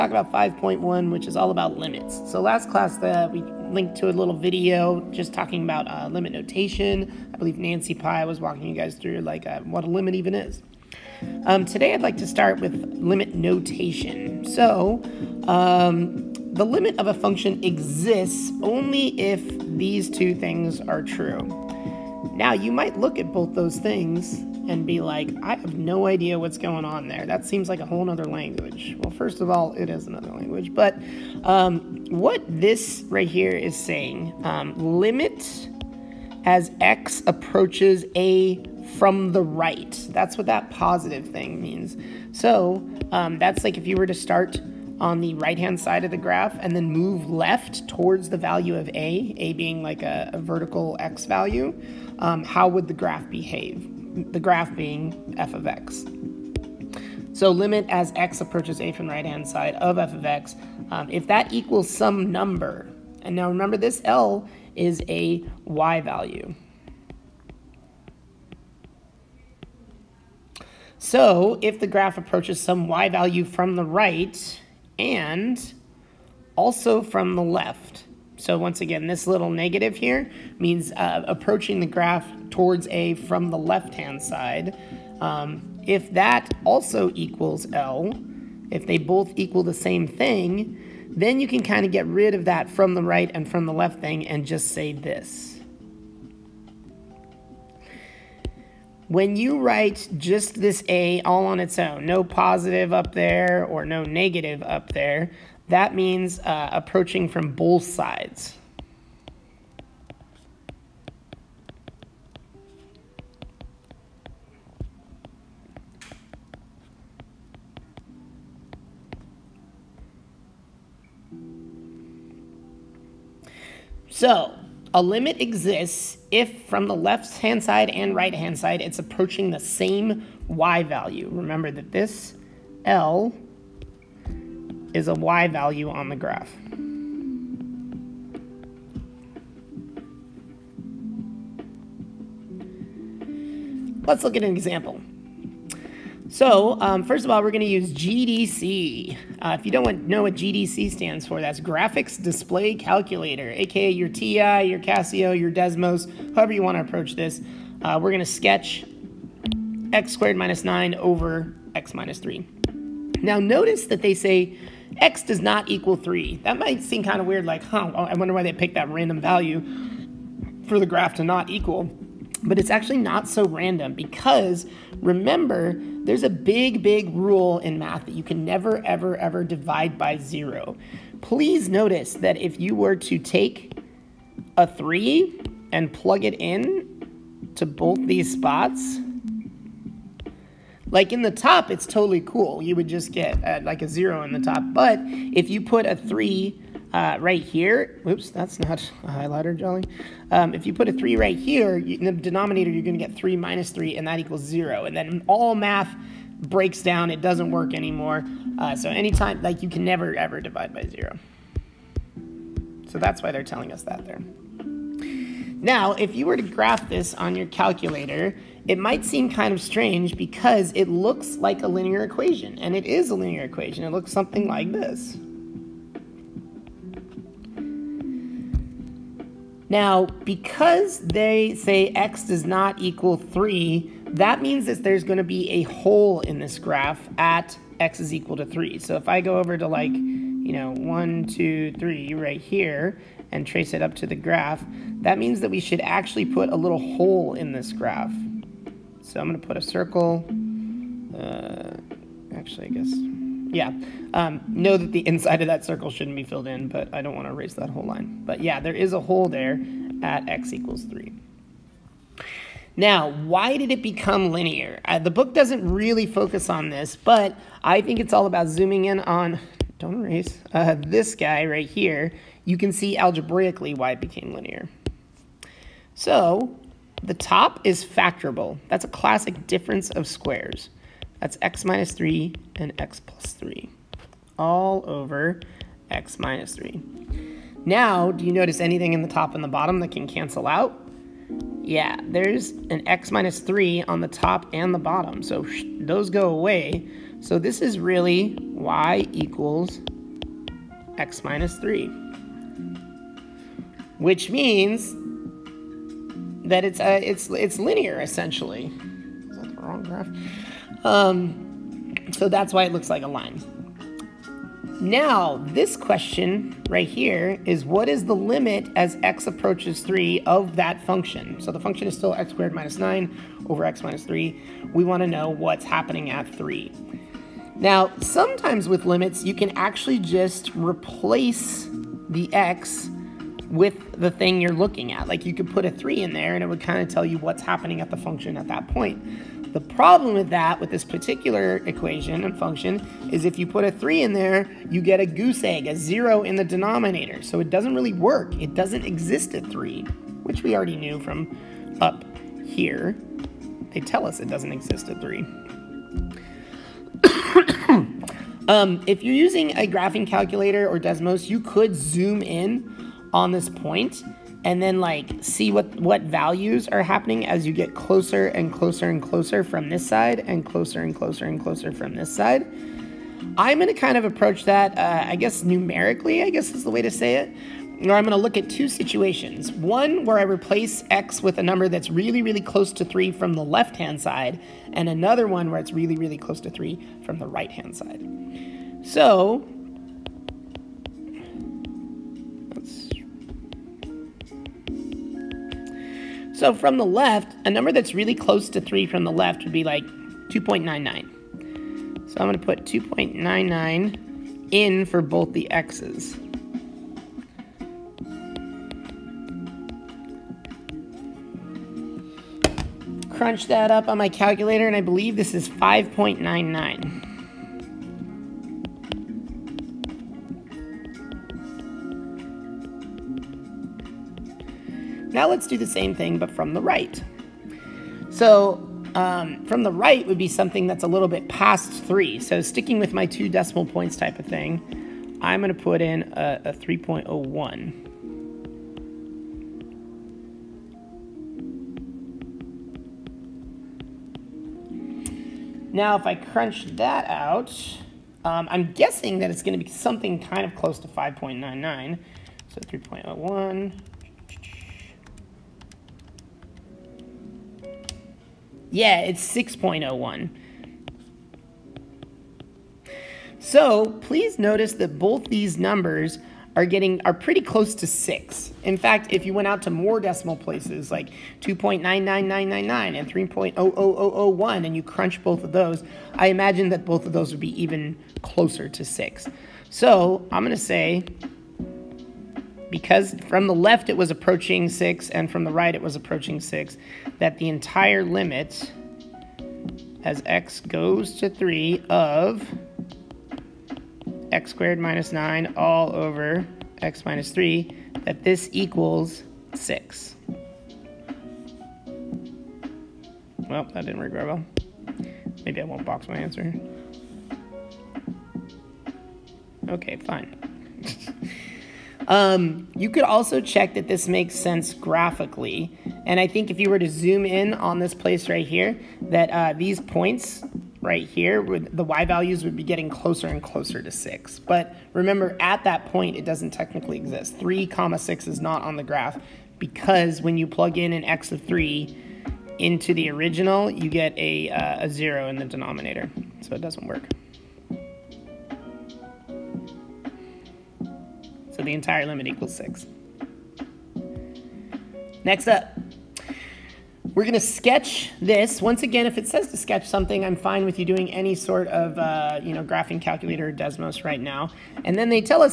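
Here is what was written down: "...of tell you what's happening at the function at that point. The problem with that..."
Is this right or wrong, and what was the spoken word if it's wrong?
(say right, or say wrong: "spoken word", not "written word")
right.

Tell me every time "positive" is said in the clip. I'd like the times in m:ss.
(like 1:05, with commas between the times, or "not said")
0:40, 1:42.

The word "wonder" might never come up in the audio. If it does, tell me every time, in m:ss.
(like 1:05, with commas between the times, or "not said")
2:48.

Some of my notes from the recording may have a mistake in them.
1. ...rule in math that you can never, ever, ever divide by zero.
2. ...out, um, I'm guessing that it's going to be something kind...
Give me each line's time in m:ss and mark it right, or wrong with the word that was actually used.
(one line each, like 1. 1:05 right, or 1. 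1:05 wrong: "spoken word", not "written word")
1. 2:57 right
2. 7:27 right.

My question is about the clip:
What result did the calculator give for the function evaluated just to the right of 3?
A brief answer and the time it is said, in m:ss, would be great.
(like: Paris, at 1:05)
6.01, at 7:39.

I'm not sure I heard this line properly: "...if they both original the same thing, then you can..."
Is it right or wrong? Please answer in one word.
wrong.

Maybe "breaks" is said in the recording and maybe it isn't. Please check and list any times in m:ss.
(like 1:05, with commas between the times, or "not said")
3:26.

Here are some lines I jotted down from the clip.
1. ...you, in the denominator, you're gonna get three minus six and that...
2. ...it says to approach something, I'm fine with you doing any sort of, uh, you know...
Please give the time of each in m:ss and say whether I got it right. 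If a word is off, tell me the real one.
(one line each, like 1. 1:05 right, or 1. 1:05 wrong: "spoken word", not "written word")
1. 3:21 wrong: "three", not "six"
2. 9:09 wrong: "sketch", not "approach".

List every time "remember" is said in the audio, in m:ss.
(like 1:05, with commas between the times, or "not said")
1:03, 2:11, 2:55, 8:44.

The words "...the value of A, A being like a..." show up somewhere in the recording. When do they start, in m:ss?
0:48.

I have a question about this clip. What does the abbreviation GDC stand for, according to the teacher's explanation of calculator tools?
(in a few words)
Graphics Display Calculator.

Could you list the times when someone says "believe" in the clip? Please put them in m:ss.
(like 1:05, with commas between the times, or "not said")
0:07, 6:54.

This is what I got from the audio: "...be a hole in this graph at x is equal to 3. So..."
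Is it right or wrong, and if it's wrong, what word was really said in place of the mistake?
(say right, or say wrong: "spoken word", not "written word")
right.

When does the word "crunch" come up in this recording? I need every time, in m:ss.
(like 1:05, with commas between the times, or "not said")
6:53, 7:26, 7:54.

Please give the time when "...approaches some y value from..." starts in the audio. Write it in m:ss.
1:12.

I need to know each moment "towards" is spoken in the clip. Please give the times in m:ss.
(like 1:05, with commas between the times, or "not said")
0:47, 1:22.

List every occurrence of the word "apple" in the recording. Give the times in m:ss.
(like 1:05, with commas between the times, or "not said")
not said.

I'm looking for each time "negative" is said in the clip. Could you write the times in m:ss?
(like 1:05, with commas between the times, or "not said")
1:19, 1:44.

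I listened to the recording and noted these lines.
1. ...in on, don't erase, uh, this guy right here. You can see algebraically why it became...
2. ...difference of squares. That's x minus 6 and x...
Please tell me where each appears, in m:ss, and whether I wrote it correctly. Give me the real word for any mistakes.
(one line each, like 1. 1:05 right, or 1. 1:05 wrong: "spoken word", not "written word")
1. 4:28 right
2. 4:39 wrong: "3", not "6".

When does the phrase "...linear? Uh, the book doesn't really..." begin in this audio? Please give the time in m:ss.
4:24.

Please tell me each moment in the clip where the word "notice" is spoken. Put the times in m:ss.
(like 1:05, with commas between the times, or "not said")
2:43, 3:01, 4:48, 7:44.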